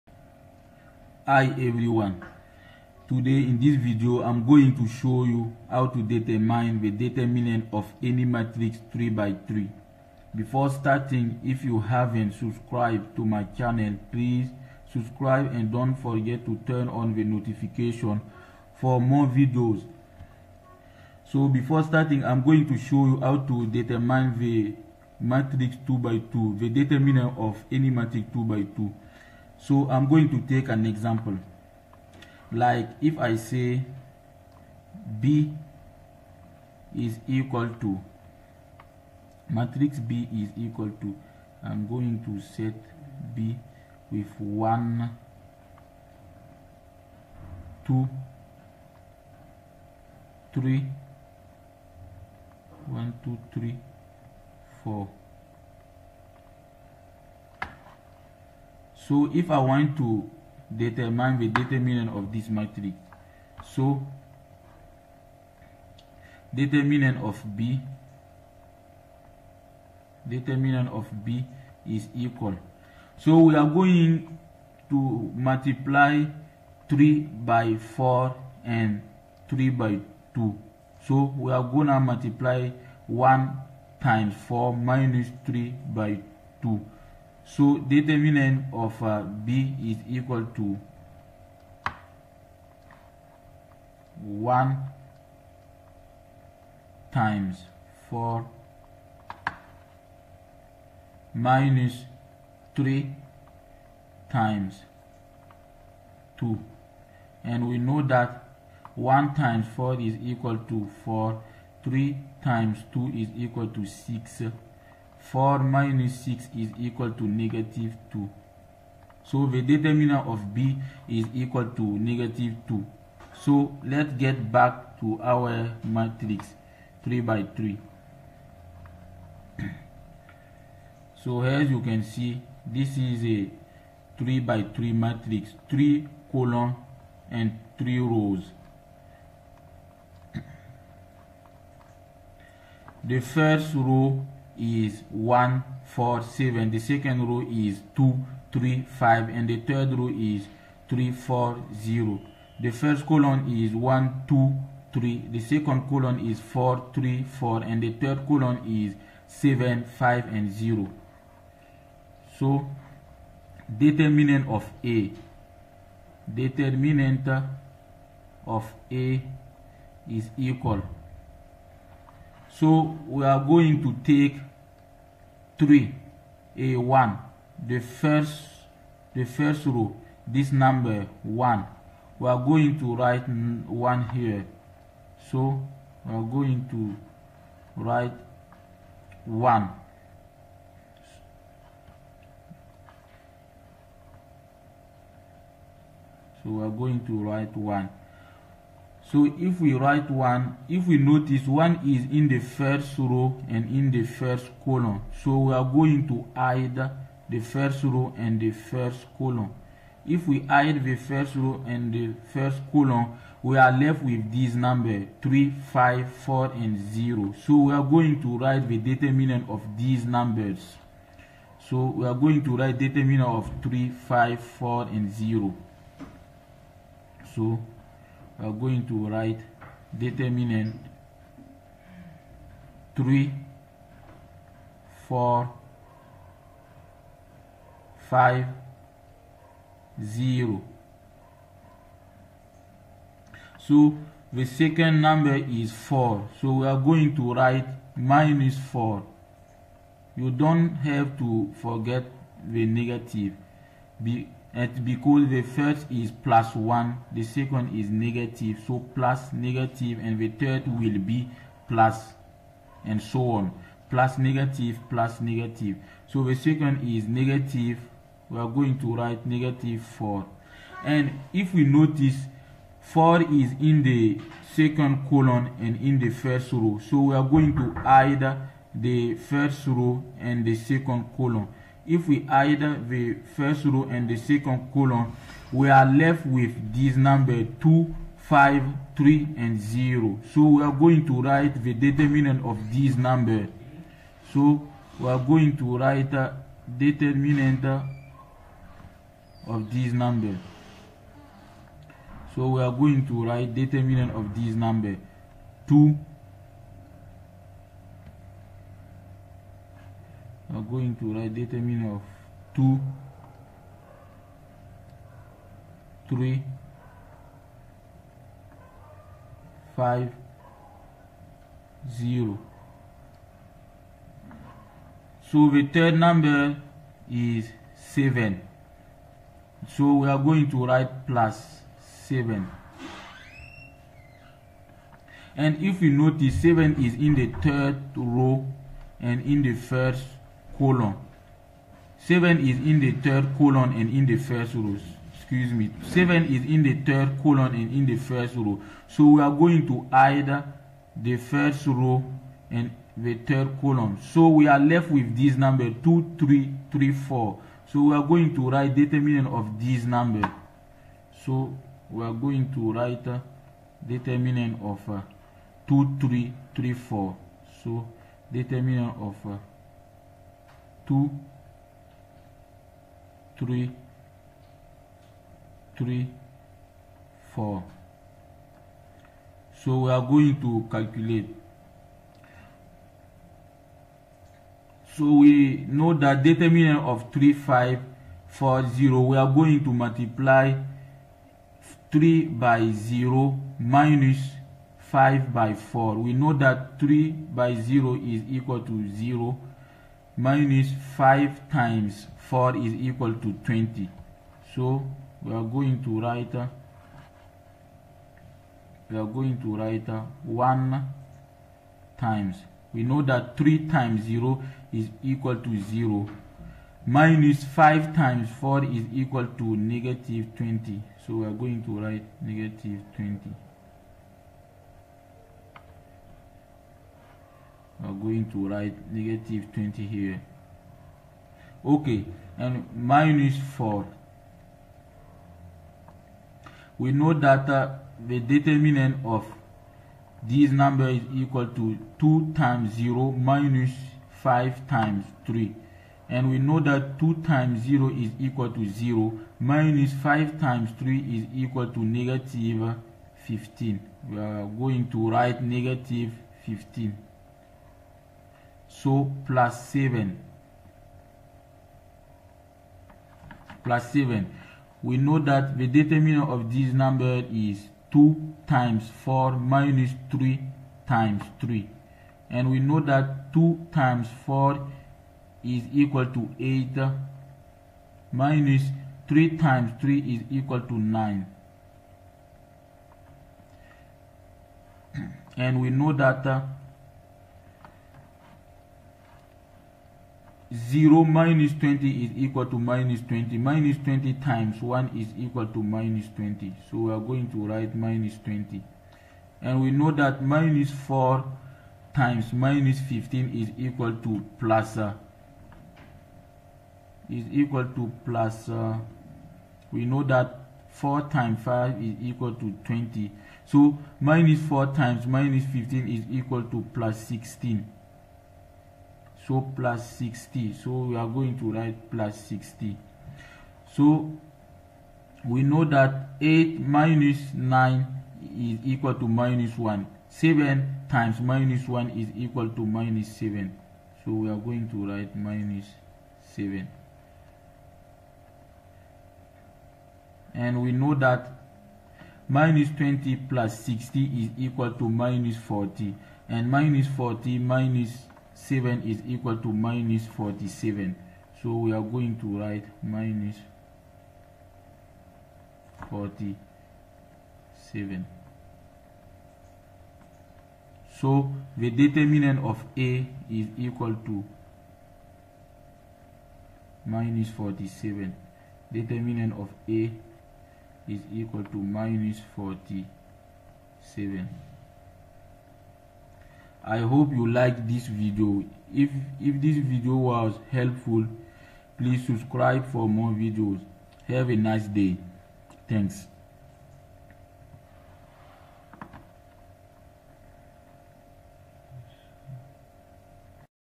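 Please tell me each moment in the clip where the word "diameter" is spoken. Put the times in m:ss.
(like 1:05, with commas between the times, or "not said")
not said.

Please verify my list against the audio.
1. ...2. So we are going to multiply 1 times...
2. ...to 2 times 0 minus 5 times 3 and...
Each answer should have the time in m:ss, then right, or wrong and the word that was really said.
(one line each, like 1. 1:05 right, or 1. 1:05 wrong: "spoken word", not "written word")
1. 1:20 right
2. 7:21 right.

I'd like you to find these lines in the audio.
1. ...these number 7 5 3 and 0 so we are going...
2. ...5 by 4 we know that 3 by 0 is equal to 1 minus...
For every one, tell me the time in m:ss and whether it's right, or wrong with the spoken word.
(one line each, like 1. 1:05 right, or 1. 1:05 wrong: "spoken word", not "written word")
1. 4:46 wrong: "2", not "7"
2. 6:34 wrong: "0", not "1".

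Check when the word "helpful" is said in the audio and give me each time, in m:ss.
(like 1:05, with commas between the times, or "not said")
9:40.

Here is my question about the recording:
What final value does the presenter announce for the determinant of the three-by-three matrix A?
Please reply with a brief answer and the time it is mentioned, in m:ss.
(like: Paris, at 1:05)
-47, at 9:21.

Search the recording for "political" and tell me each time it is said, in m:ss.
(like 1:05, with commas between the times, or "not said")
not said.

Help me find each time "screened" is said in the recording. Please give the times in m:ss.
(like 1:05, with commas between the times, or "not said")
not said.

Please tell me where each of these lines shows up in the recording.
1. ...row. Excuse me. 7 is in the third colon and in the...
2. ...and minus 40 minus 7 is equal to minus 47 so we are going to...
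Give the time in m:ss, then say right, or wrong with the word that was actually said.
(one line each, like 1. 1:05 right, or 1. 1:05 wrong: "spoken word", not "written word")
1. 5:44 right
2. 9:06 right.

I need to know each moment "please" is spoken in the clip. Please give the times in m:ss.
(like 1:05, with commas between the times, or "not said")
0:14, 9:41.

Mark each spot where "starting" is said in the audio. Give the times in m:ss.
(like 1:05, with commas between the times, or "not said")
0:10, 0:21.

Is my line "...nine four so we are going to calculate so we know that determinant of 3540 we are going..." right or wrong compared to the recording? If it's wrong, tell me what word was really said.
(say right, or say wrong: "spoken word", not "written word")
wrong: "three", not "nine".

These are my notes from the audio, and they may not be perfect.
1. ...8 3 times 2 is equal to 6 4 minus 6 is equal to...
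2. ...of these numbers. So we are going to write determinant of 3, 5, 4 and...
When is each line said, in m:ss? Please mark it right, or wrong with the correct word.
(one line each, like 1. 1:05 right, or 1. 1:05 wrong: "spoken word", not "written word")
1. 1:51 wrong: "4", not "8"
2. 3:39 right.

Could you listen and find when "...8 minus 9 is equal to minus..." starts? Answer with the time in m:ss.
8:46.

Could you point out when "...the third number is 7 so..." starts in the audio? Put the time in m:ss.
5:25.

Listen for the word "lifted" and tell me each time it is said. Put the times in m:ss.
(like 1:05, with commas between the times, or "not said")
not said.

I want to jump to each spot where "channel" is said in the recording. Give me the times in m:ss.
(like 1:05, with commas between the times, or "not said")
0:13.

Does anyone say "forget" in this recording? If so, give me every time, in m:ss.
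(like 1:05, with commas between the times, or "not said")
0:15, 4:11.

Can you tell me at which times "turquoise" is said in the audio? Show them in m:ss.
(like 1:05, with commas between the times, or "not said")
not said.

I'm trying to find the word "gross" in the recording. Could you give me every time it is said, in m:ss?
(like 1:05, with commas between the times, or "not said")
not said.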